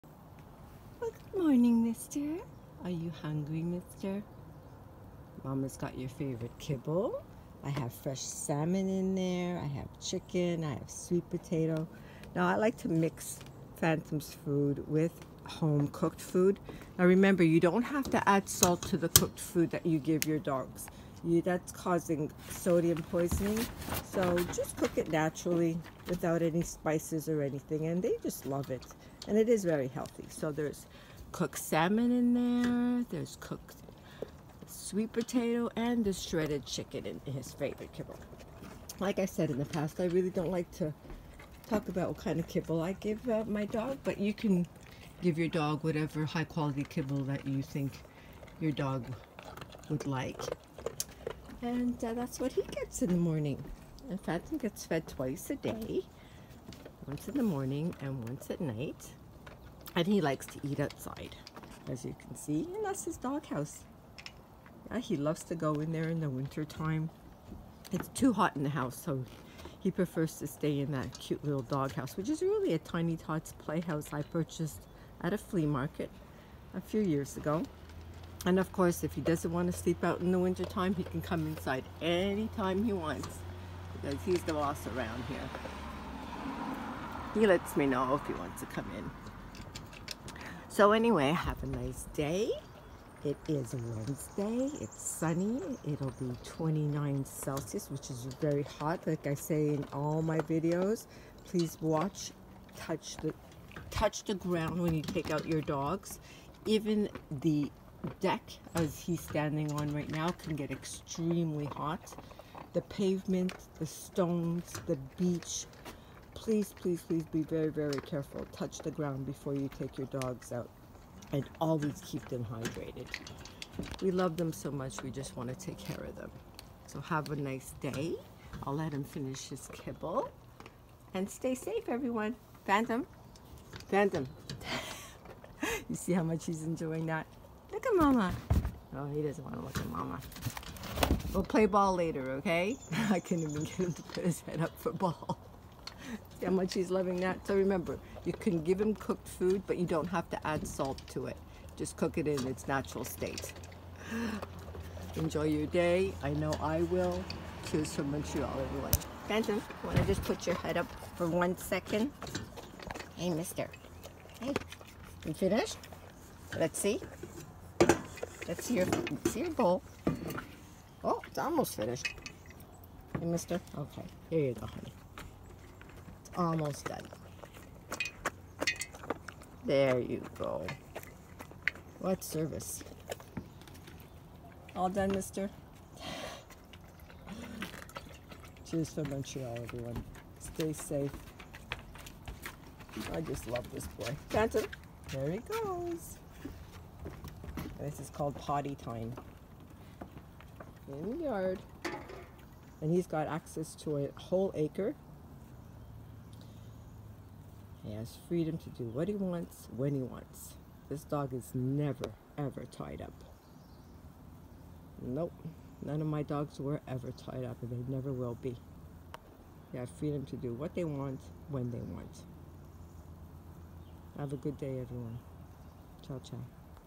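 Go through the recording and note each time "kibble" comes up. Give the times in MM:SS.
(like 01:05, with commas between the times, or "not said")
00:06, 00:37, 00:42, 00:46, 02:09.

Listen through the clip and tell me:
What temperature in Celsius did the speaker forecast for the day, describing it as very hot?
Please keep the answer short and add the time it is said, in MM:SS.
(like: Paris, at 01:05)
29, at 01:36.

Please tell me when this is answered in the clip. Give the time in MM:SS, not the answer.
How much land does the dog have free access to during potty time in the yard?
03:23.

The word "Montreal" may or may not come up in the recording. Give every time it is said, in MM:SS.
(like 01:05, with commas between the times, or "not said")
02:38, 03:09.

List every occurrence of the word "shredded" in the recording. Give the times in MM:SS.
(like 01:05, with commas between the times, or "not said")
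00:36.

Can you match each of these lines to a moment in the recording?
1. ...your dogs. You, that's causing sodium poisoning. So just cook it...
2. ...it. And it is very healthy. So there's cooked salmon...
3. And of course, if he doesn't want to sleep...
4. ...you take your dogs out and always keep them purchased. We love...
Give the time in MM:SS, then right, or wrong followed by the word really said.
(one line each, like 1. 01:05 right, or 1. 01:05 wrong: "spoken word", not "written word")
1. 00:20 right
2. 00:28 right
3. 01:18 right
4. 01:59 wrong: "hydrated", not "purchased".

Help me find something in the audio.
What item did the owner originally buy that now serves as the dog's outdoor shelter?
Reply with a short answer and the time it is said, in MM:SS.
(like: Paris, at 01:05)
Tiny Tots playhouse, at 01:12.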